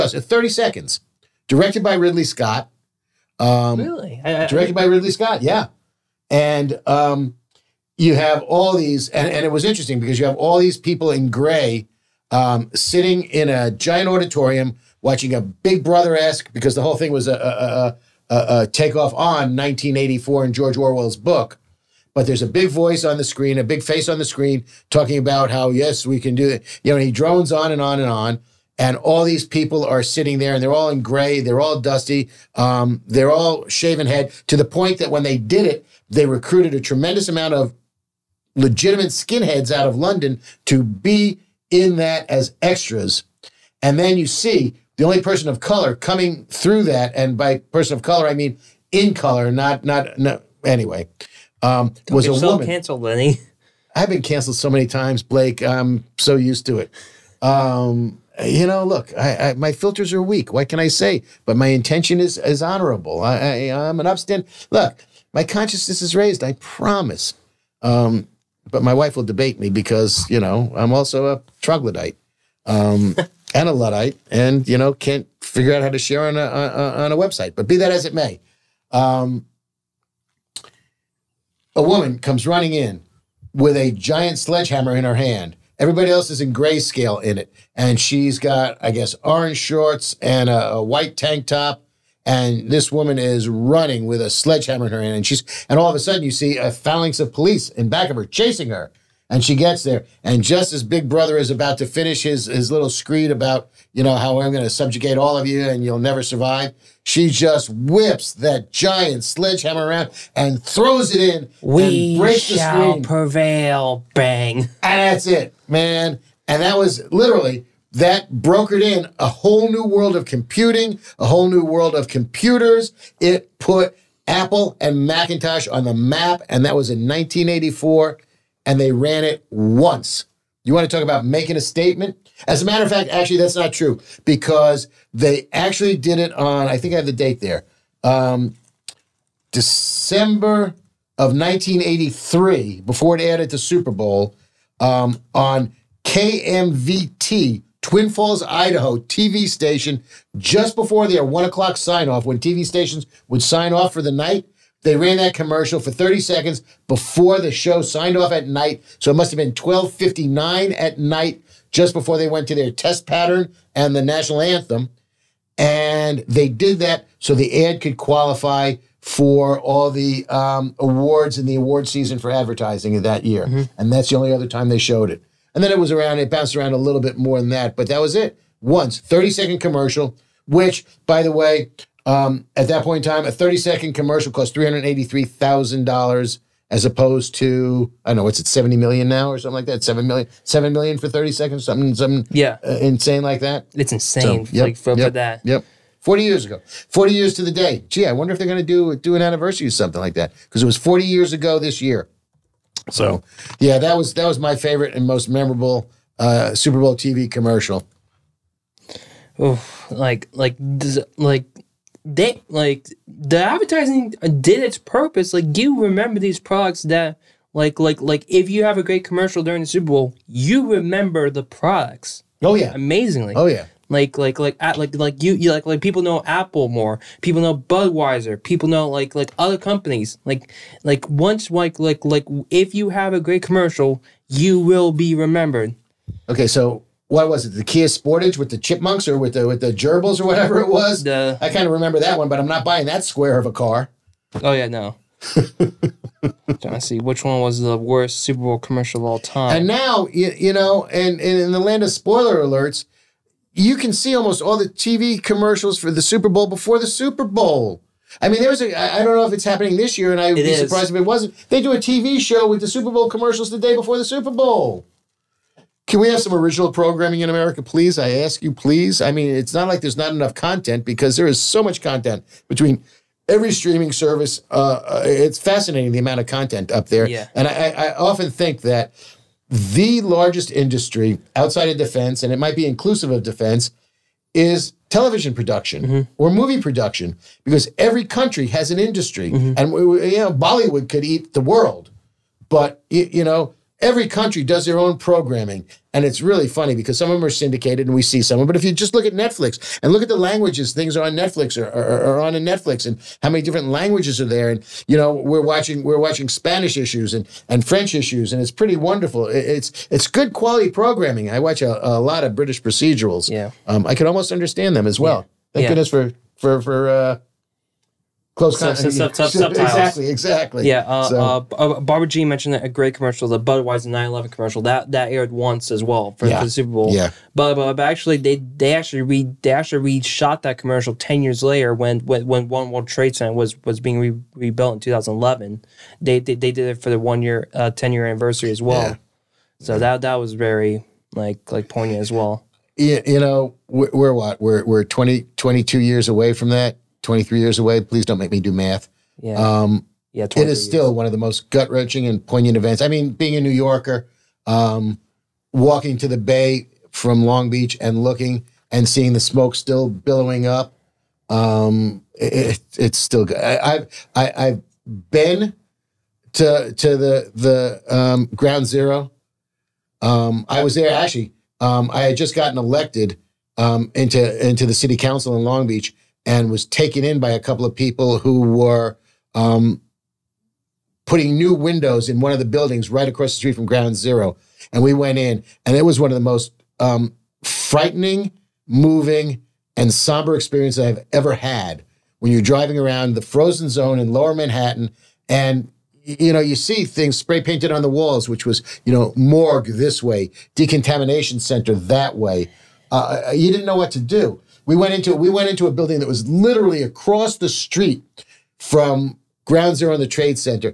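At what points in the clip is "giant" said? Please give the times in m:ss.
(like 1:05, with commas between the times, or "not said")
0:13, 1:23, 1:48.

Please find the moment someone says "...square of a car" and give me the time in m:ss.
4:03.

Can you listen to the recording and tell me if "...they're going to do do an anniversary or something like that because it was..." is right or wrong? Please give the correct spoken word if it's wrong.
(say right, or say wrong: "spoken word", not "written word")
right.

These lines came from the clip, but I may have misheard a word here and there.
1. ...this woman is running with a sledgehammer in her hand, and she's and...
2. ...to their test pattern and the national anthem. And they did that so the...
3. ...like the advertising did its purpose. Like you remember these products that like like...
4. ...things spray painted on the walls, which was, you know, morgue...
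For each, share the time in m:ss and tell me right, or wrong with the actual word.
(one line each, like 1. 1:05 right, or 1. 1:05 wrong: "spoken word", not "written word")
1. 1:32 right
2. 2:42 right
3. 3:32 right
4. 6:36 right.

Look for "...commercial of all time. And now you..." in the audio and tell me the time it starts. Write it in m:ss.
4:08.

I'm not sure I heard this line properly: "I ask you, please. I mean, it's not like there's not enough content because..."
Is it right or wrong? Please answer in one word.
right.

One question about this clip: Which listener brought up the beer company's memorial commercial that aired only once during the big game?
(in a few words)
Barbara G.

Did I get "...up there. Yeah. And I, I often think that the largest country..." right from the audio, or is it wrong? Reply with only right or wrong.
wrong.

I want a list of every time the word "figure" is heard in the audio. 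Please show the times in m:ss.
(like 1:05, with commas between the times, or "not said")
1:15.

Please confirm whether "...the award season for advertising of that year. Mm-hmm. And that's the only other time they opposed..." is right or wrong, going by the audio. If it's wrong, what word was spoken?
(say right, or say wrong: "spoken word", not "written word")
wrong: "showed", not "opposed".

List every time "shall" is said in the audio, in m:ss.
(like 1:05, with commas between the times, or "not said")
1:52.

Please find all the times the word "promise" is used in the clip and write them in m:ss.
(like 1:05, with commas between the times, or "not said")
1:06.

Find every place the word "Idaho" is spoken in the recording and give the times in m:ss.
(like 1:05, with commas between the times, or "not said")
2:28.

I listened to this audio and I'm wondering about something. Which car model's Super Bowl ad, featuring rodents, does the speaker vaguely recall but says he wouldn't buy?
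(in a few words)
Kia Sportage.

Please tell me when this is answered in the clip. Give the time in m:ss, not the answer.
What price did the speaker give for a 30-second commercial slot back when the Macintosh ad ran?
3:04.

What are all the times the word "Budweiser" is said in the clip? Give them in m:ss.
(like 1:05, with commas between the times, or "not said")
3:47, 5:23.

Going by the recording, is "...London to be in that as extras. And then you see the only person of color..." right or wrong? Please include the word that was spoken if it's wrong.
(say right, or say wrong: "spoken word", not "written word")
right.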